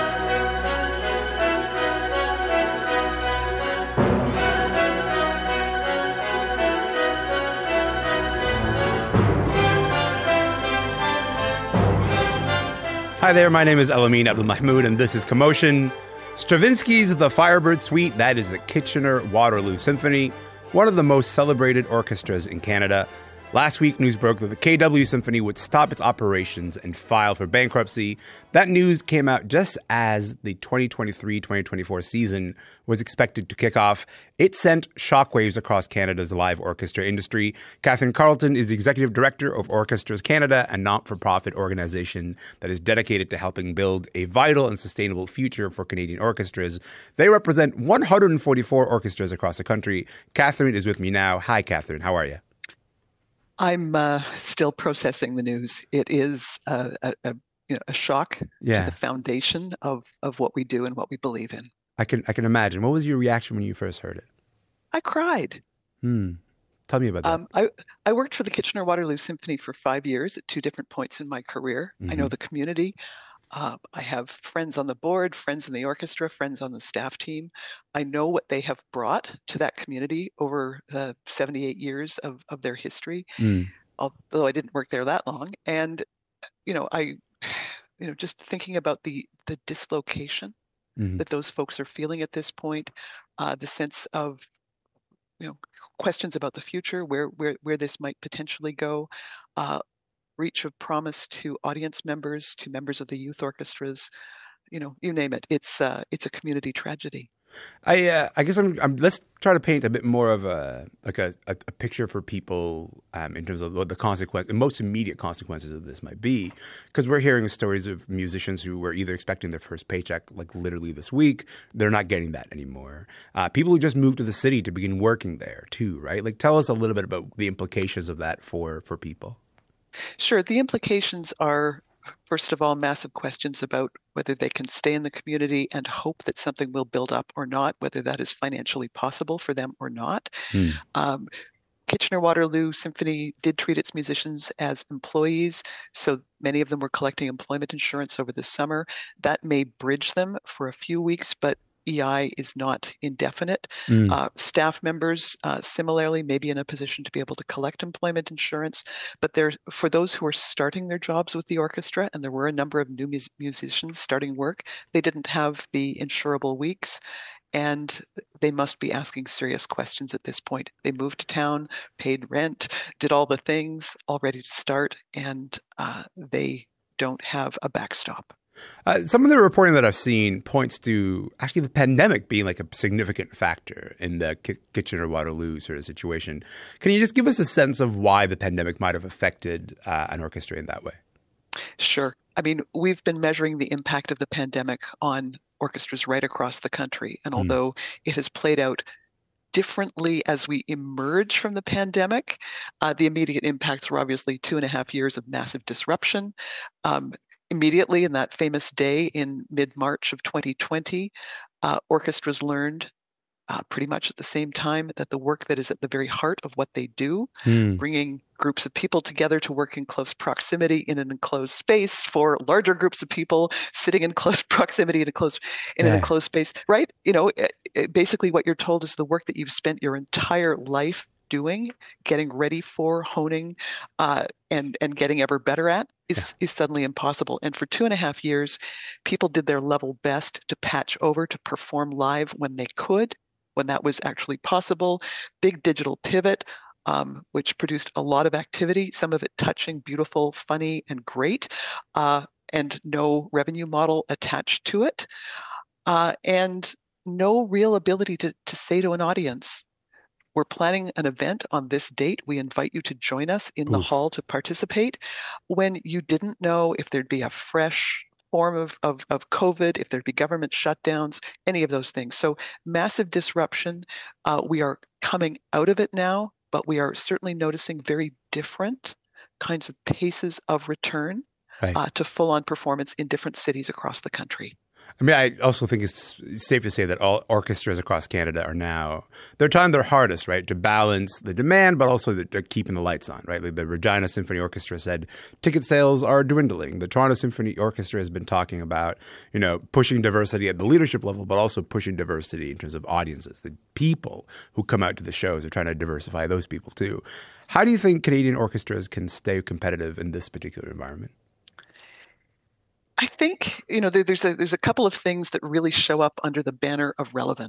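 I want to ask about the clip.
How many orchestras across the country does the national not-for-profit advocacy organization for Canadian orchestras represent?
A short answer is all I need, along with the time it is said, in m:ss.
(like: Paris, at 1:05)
144, at 0:47.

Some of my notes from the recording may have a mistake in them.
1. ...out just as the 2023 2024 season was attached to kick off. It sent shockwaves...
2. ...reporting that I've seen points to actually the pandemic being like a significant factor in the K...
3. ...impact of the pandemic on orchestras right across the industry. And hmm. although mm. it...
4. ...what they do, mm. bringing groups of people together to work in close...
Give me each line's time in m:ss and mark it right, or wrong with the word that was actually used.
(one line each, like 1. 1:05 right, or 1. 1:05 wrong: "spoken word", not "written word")
1. 0:29 wrong: "expected", not "attached"
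2. 2:59 right
3. 3:13 wrong: "country", not "industry"
4. 3:36 right.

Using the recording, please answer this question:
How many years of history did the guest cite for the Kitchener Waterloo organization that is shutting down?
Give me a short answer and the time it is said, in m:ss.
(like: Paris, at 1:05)
78, at 1:21.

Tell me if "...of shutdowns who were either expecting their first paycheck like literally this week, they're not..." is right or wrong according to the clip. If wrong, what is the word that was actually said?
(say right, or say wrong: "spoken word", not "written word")
wrong: "musicians", not "shutdowns".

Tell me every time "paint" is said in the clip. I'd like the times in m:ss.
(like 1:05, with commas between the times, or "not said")
1:49.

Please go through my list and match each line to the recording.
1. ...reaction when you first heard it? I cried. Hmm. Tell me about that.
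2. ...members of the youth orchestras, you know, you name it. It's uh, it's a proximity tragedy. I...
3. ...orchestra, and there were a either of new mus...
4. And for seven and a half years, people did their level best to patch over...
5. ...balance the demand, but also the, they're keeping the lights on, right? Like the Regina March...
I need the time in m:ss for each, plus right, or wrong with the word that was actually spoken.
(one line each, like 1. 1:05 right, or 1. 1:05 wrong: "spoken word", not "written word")
1. 1:03 right
2. 1:42 wrong: "community", not "proximity"
3. 2:41 wrong: "number", not "either"
4. 3:57 wrong: "two", not "seven"
5. 4:50 wrong: "Symphony", not "March".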